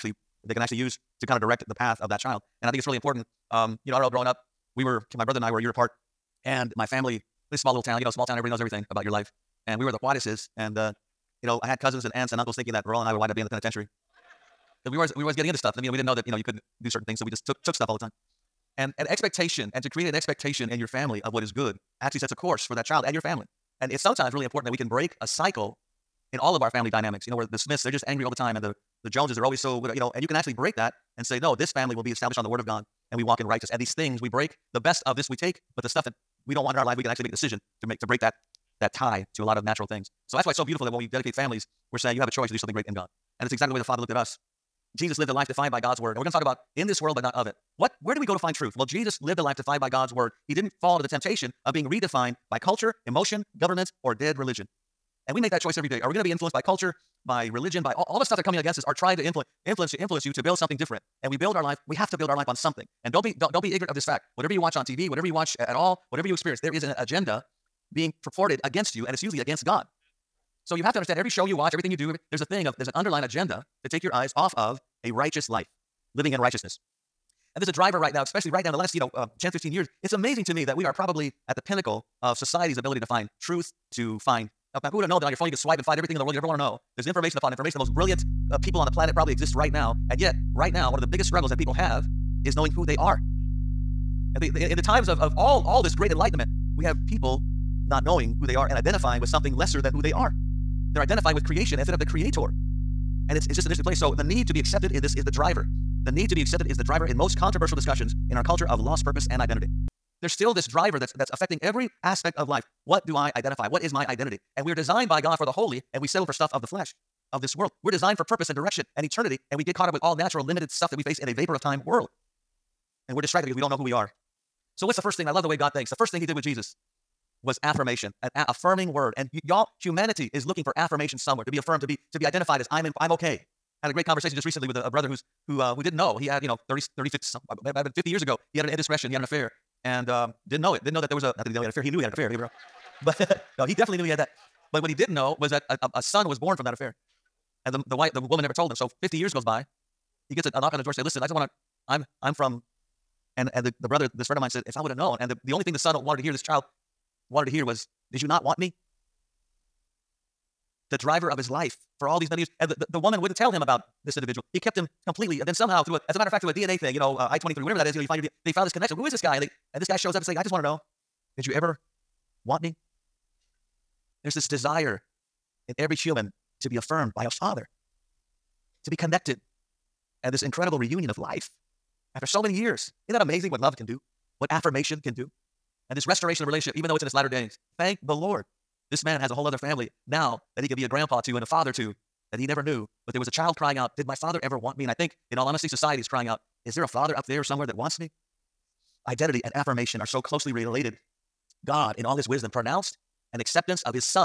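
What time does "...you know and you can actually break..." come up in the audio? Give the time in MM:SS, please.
00:29.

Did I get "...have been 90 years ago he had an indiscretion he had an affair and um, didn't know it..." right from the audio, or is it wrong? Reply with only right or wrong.
wrong.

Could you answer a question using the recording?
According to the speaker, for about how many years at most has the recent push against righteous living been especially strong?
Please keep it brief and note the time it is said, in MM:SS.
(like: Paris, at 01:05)
15, at 01:19.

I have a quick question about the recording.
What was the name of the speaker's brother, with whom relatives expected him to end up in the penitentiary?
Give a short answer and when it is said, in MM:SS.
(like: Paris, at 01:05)
Raul, at 00:12.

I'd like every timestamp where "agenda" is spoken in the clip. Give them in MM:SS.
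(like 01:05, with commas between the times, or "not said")
01:06, 01:13.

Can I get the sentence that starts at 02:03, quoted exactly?
And we're distracted because we don't know who we are.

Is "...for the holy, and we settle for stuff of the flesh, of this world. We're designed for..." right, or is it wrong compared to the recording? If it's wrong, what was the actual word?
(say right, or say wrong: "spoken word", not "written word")
right.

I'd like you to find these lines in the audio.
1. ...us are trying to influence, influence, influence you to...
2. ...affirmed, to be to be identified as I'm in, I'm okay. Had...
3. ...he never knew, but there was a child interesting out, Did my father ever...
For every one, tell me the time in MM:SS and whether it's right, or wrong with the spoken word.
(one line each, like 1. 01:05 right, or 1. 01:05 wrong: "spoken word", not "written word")
1. 00:58 right
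2. 02:11 right
3. 03:12 wrong: "crying", not "interesting".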